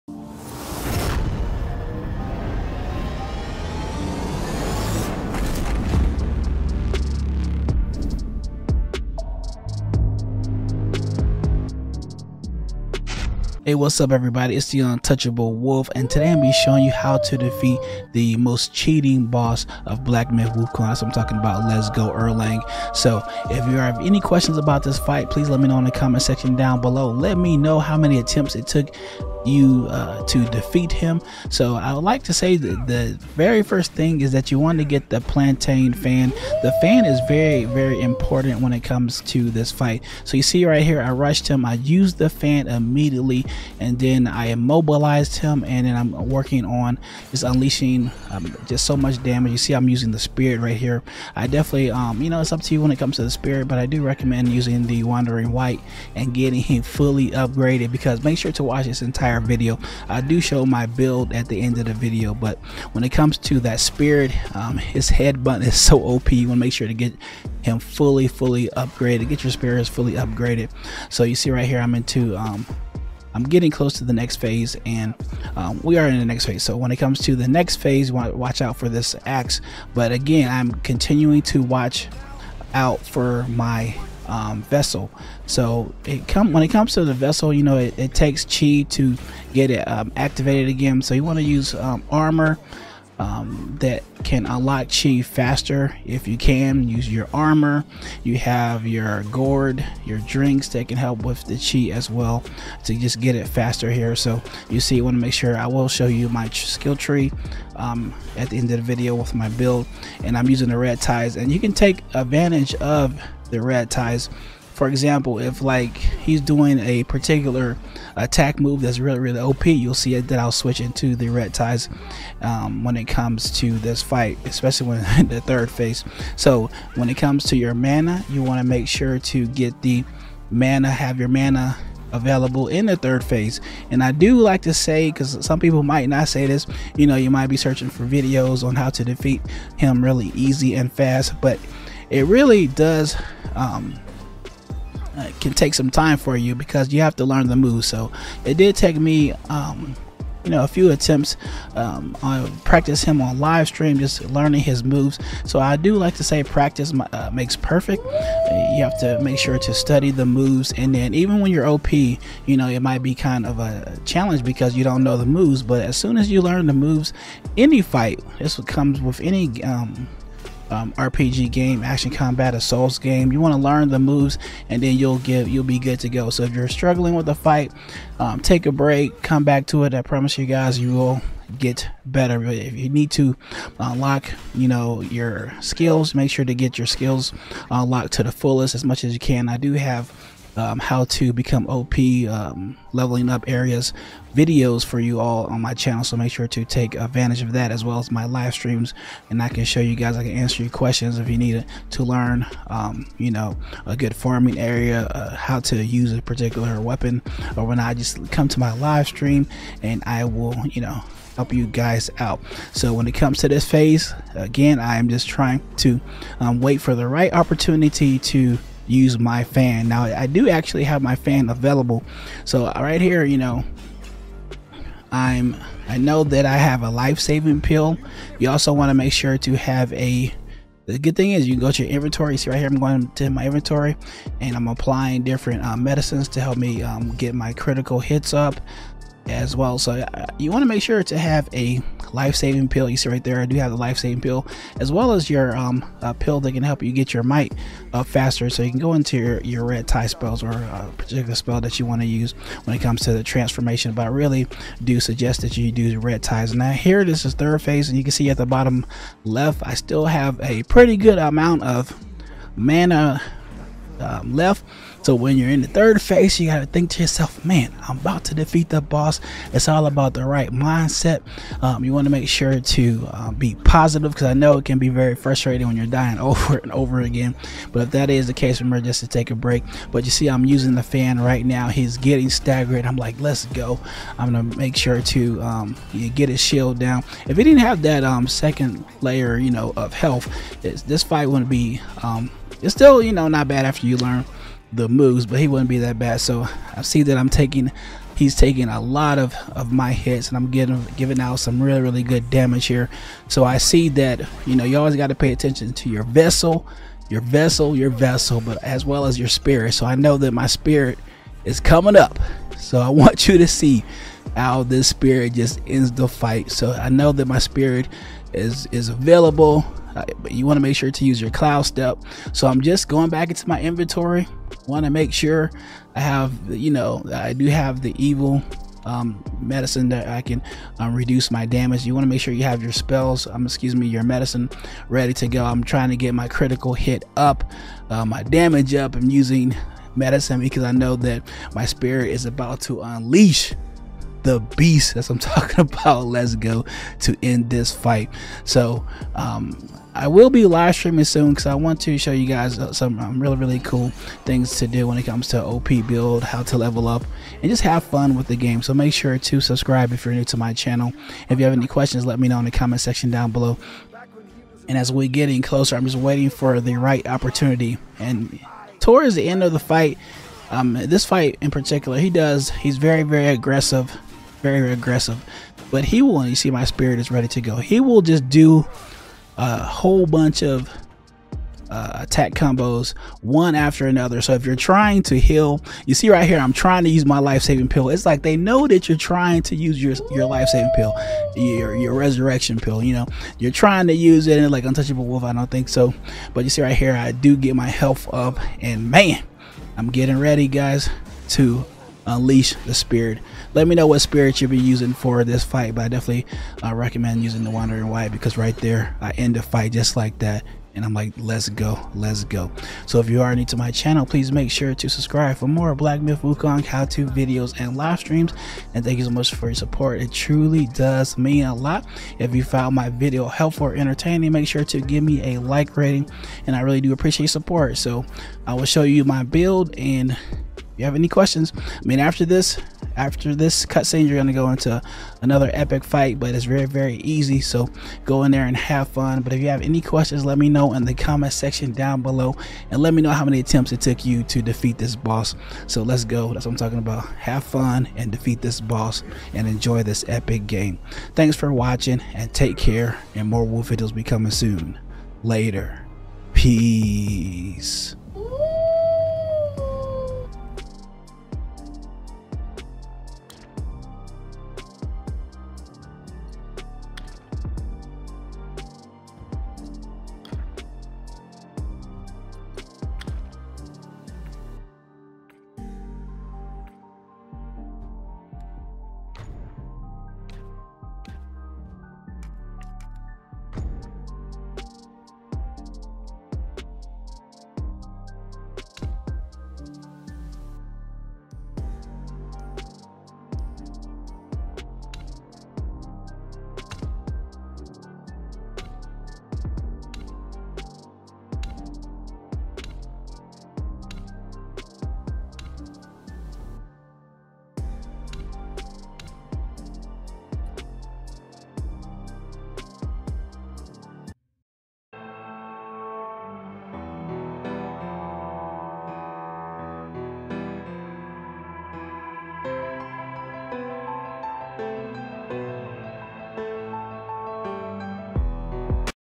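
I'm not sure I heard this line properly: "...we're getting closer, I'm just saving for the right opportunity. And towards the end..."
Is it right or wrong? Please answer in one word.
wrong.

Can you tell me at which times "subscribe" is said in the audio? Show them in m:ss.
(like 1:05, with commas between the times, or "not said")
5:59, 6:54.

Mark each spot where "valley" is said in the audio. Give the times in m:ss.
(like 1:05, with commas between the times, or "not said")
not said.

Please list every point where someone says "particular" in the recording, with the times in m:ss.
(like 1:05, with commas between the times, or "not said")
1:57, 3:26, 4:10, 6:11.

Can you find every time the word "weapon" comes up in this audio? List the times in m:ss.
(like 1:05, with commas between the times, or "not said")
3:26.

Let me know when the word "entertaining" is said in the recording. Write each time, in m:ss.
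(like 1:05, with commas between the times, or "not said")
7:03.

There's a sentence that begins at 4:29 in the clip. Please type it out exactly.
It's all about the right mindset.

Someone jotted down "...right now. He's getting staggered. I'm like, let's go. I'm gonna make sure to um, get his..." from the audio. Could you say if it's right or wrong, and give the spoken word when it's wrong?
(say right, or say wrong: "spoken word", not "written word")
right.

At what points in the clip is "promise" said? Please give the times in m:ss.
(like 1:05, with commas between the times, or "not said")
3:00.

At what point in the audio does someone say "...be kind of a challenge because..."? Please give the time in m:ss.
2:43.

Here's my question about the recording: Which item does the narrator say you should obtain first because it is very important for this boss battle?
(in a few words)
Plantain fan.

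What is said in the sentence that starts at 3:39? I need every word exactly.
Now I do actually have my fan available.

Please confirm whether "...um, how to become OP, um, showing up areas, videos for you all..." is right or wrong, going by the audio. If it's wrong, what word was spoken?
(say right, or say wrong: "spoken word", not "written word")
wrong: "leveling", not "showing".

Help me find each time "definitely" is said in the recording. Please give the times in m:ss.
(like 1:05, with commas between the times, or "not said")
0:51, 6:45.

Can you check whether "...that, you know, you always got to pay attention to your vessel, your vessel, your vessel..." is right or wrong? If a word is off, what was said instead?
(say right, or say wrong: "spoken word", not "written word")
right.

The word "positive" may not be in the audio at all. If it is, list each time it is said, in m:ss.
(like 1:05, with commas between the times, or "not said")
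4:33.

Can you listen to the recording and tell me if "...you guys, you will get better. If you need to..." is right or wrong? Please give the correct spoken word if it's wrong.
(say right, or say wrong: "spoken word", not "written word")
right.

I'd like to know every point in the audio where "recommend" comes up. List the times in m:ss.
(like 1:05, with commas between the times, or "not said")
0:54, 6:46.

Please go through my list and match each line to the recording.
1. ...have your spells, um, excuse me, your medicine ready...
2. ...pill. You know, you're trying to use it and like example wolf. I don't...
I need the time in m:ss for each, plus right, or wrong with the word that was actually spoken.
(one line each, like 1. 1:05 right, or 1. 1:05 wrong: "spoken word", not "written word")
1. 5:32 right
2. 6:32 wrong: "untouchable", not "example".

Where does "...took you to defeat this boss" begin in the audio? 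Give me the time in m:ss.
7:23.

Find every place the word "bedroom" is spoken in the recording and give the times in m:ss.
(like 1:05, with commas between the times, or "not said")
not said.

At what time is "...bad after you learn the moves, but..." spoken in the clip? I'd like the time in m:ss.
4:53.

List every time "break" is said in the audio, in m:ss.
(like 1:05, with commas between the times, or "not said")
2:58, 4:39.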